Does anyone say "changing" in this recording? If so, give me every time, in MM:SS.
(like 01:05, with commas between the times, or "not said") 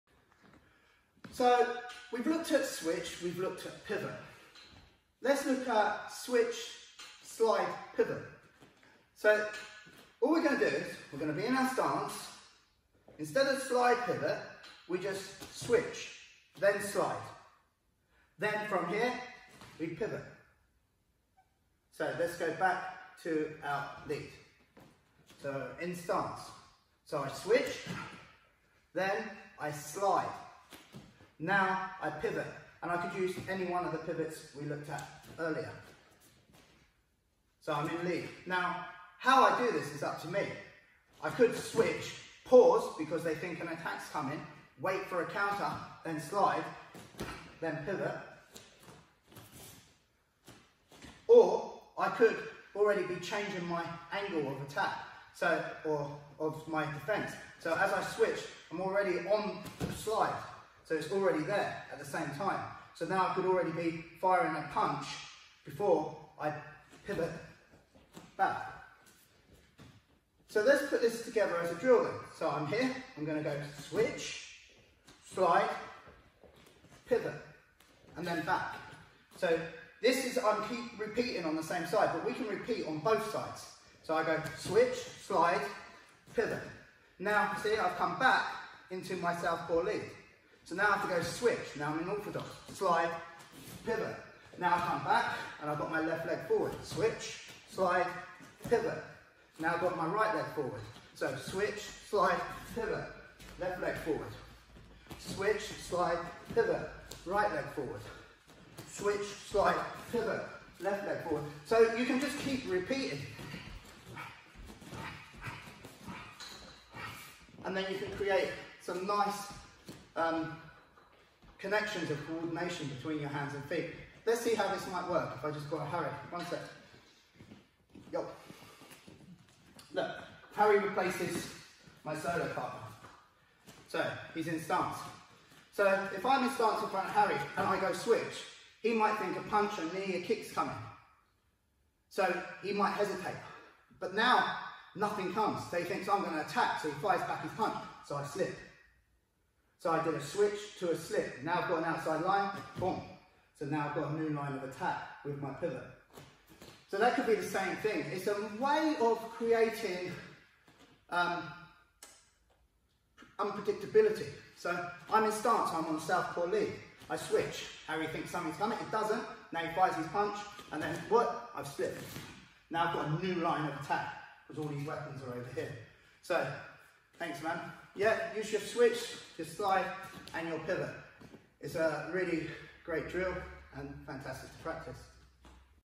00:53.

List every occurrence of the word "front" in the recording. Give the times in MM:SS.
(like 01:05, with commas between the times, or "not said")
02:16.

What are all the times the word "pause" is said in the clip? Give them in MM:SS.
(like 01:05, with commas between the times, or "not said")
00:42.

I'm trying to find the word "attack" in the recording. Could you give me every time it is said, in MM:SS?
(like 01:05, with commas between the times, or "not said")
00:43, 00:54, 02:26, 02:34, 02:53.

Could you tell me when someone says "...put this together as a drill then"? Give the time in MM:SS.
01:10.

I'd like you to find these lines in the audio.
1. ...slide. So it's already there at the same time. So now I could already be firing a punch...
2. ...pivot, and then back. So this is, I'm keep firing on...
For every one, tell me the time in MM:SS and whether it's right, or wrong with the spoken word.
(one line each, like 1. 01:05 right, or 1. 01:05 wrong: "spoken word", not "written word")
1. 00:59 right
2. 01:17 wrong: "repeating", not "firing".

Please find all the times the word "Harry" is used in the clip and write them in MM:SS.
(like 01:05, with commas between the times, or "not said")
02:10, 02:17, 02:47.